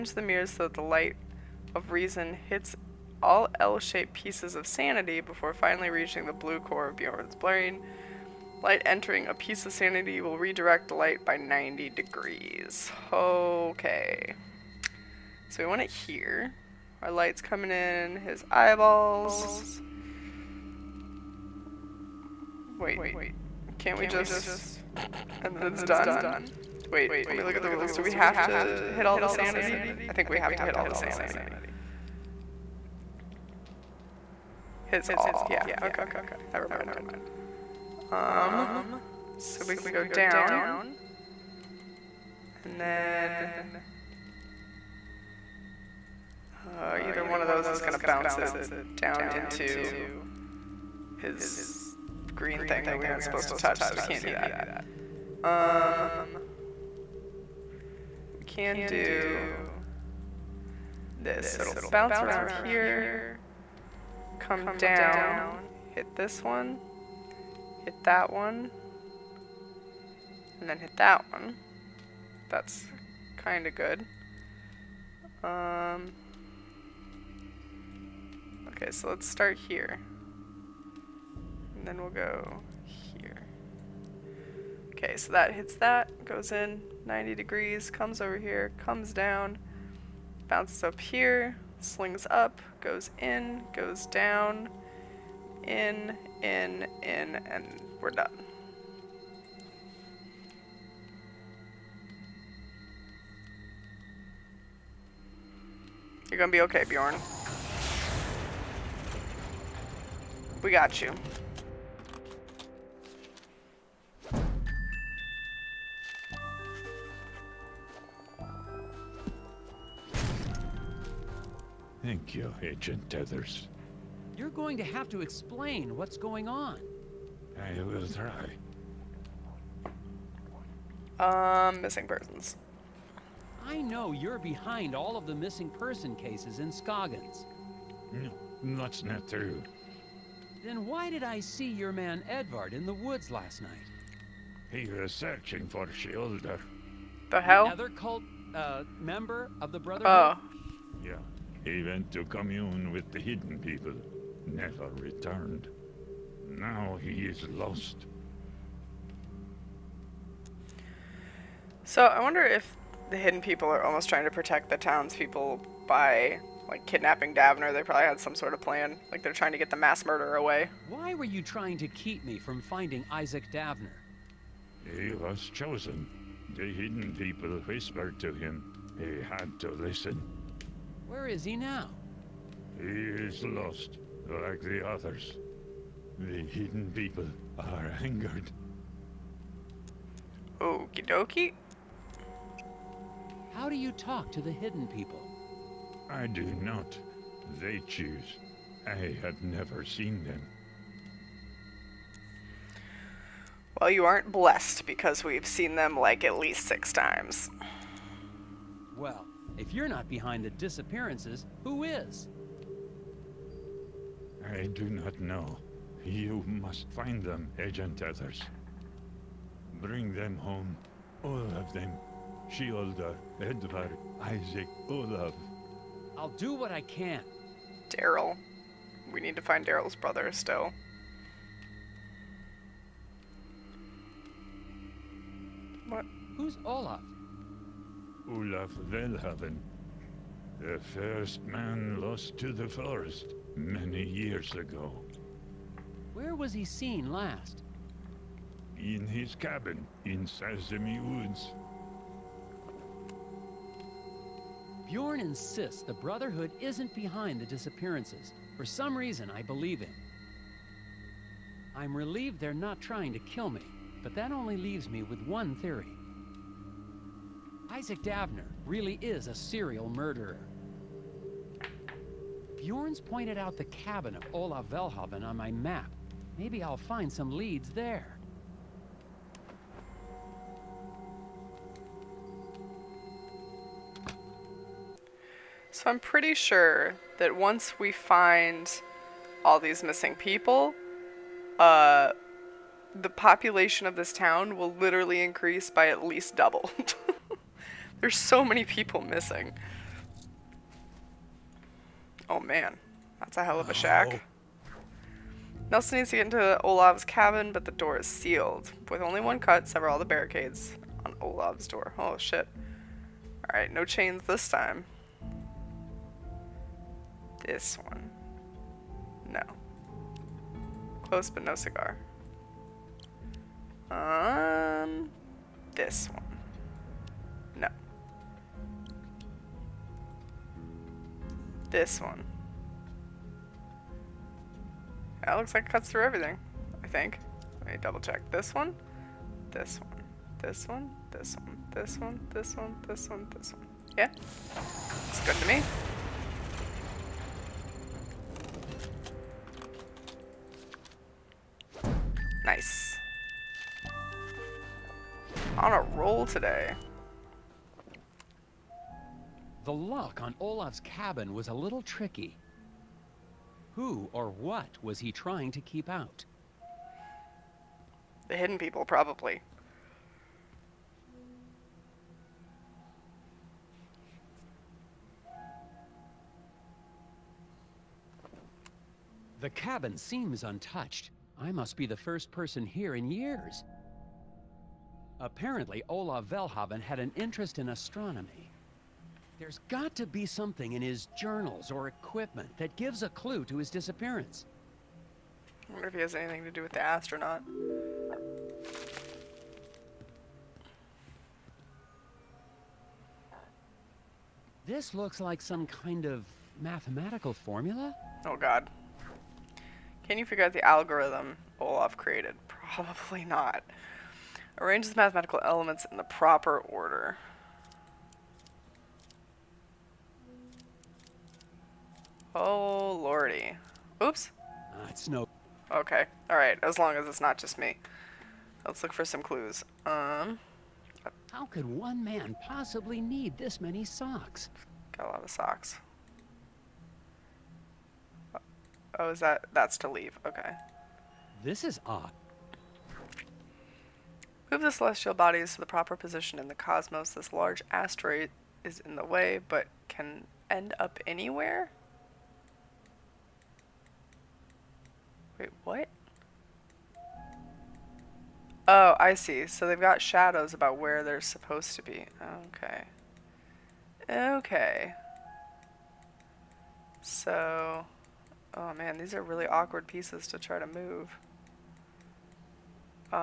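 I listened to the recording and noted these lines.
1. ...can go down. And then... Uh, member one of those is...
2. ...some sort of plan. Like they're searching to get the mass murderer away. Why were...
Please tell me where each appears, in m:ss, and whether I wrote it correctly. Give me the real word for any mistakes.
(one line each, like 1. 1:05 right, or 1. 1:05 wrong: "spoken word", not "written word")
1. 0:39 wrong: "either", not "member"
2. 2:48 wrong: "trying", not "searching".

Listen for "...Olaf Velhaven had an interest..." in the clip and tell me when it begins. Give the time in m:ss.
6:25.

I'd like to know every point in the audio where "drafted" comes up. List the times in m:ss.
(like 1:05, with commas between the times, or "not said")
not said.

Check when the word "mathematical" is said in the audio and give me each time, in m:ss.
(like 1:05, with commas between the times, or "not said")
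6:46, 6:54.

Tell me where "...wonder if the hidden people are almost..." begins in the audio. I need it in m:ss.
2:42.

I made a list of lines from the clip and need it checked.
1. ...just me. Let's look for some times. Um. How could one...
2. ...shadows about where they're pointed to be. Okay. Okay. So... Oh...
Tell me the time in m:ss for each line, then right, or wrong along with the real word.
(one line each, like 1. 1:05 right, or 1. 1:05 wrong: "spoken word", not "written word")
1. 7:07 wrong: "clues", not "times"
2. 7:40 wrong: "supposed", not "pointed".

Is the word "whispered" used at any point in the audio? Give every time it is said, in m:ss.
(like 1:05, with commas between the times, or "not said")
2:57.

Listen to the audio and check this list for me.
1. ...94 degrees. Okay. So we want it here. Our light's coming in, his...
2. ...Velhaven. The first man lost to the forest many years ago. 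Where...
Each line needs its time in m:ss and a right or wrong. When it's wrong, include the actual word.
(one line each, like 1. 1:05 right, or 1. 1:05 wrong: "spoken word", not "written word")
1. 0:11 wrong: "90", not "94"
2. 3:58 right.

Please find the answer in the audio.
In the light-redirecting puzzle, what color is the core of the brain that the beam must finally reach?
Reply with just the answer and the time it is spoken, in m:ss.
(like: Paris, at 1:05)
Blue, at 0:06.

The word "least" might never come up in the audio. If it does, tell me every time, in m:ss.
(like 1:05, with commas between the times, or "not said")
3:26, 4:56.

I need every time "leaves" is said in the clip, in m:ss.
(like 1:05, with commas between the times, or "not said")
4:24, 7:19.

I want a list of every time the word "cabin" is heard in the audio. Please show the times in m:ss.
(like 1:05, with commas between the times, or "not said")
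4:09, 4:33, 5:07, 6:00, 6:19.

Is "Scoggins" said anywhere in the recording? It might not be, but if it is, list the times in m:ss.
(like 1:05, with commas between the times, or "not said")
2:16.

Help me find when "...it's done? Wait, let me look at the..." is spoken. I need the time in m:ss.
0:25.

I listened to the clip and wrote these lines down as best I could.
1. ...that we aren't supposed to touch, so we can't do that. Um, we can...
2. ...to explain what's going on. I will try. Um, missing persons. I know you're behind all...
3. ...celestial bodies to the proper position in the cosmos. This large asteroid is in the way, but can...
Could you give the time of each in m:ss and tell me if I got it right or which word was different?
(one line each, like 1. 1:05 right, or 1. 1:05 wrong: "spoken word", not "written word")
1. 0:52 right
2. 2:05 right
3. 7:24 right.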